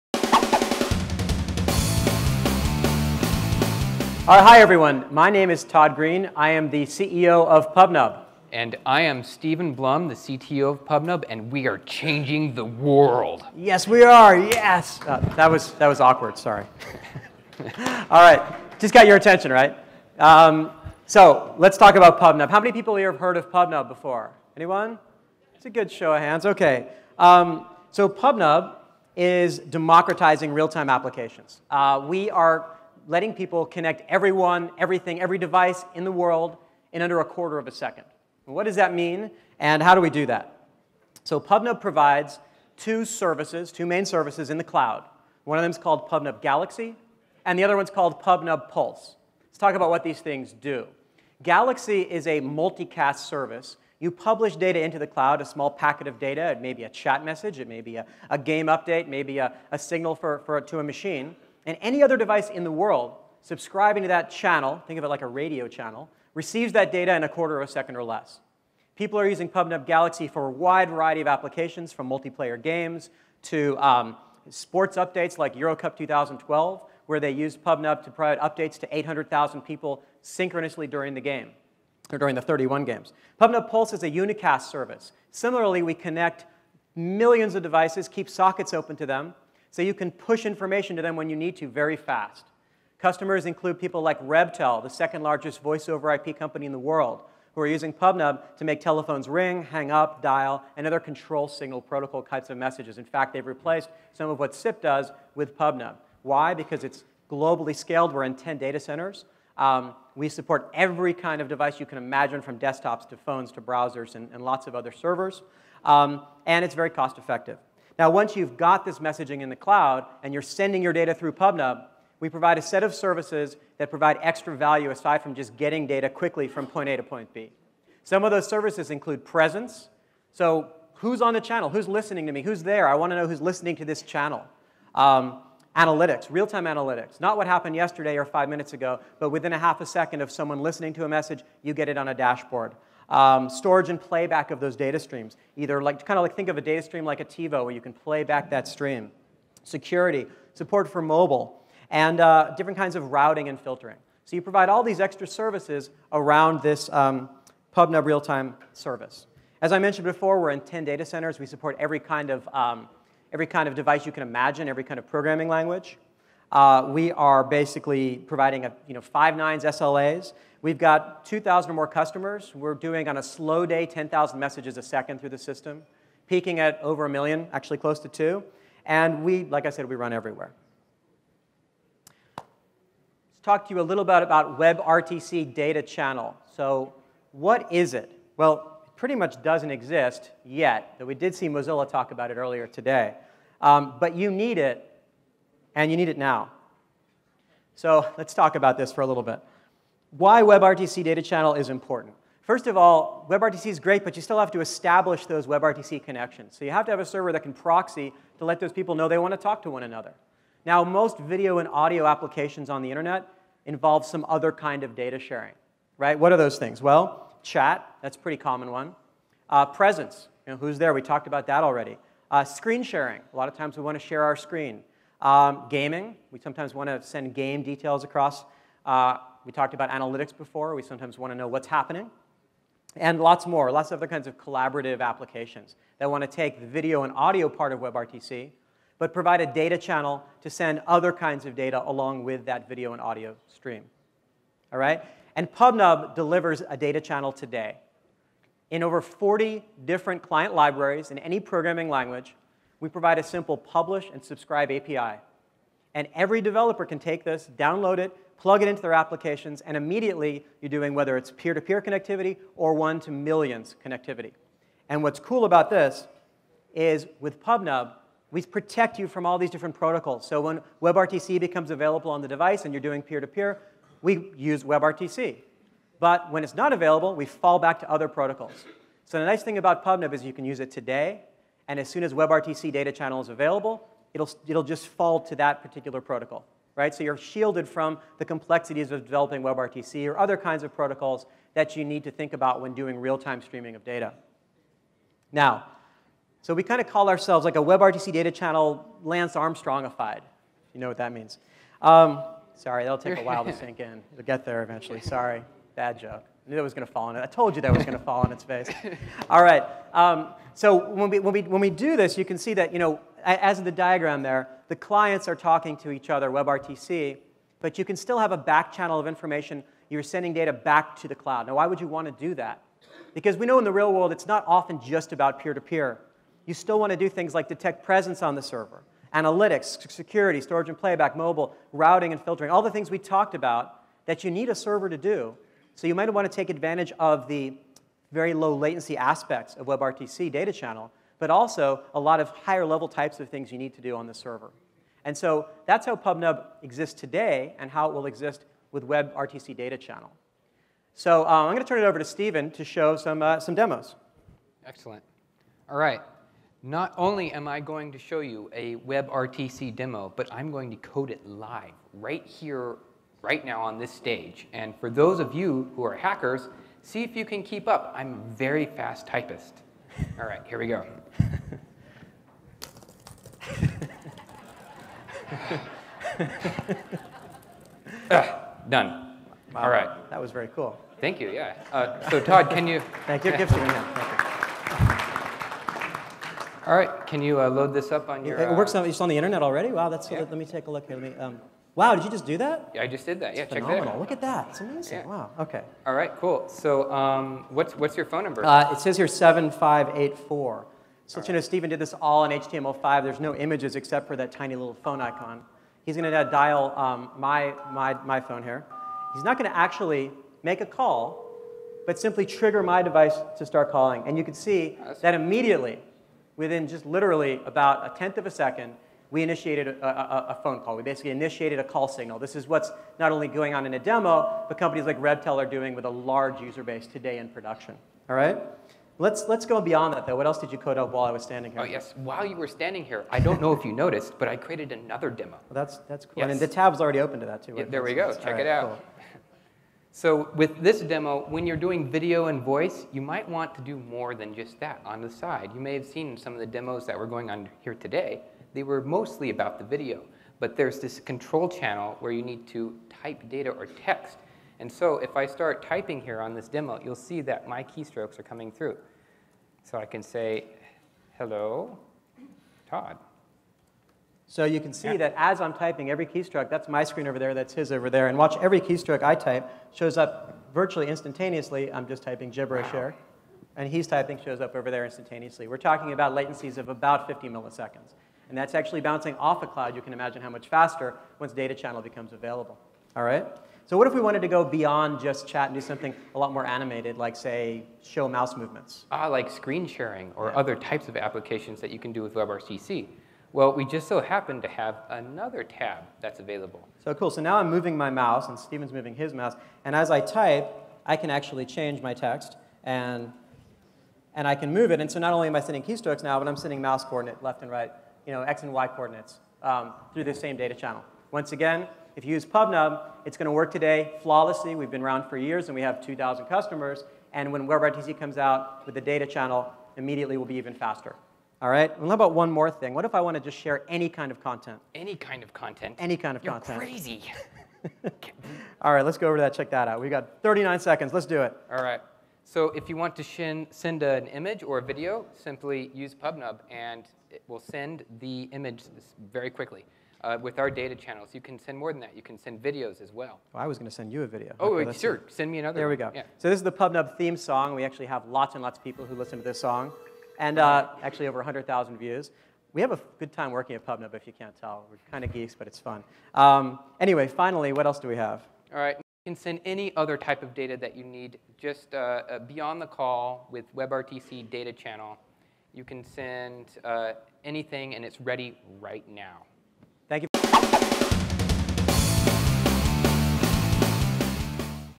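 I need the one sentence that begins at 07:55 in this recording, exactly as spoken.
We're talking about latencies of about 50 milliseconds and that's actually bouncing off a cloud.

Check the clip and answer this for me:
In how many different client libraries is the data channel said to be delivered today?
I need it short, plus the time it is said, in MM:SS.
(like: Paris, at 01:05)
over 40, at 04:08.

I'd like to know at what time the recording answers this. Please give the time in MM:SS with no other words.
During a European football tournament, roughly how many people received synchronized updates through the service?
01:18.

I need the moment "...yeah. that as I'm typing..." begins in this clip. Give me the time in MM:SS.
07:44.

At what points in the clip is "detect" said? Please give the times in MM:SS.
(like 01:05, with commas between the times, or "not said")
05:27.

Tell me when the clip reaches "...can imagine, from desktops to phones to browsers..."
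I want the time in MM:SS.
01:51.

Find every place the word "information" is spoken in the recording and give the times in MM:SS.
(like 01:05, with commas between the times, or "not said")
01:30, 05:19.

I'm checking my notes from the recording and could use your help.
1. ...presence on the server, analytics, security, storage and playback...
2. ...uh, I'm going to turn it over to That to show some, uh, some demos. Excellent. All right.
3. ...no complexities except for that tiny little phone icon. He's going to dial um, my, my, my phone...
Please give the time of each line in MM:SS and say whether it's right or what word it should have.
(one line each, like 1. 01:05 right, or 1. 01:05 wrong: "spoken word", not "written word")
1. 05:27 right
2. 05:51 wrong: "Stephen", not "That"
3. 06:43 wrong: "images", not "complexities".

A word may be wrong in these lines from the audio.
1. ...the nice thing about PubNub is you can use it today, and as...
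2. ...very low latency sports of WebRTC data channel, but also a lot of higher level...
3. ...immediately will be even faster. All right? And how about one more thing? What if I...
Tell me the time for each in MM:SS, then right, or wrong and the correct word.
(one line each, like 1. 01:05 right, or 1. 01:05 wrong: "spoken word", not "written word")
1. 04:39 right
2. 05:38 wrong: "aspects", not "sports"
3. 08:39 right.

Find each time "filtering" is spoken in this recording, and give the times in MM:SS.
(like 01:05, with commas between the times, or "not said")
02:33, 05:32.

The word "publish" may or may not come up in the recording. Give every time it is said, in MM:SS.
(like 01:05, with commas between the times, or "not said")
00:54, 04:13.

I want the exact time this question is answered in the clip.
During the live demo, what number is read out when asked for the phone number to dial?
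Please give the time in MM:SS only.
06:39.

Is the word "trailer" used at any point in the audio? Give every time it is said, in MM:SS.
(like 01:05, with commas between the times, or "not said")
not said.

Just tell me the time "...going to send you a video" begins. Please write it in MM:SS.
09:03.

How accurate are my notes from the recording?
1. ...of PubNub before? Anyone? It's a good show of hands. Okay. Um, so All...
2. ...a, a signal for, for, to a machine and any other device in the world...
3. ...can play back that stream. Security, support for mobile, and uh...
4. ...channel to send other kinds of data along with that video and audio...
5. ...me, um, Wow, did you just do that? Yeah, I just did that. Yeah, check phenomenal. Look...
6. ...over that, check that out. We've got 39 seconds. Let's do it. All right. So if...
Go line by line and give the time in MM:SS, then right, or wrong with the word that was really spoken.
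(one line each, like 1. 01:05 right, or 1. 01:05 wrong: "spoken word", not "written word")
1. 00:23 wrong: "PubNub", not "All"
2. 00:59 right
3. 02:27 right
4. 03:59 right
5. 06:31 right
6. 08:49 right.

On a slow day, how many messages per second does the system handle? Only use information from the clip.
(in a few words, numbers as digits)
10,000.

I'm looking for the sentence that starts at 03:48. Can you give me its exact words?
Uh, we talked about analytics before.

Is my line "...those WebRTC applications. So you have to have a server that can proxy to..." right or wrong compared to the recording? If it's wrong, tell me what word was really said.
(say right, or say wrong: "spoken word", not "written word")
wrong: "connections", not "applications".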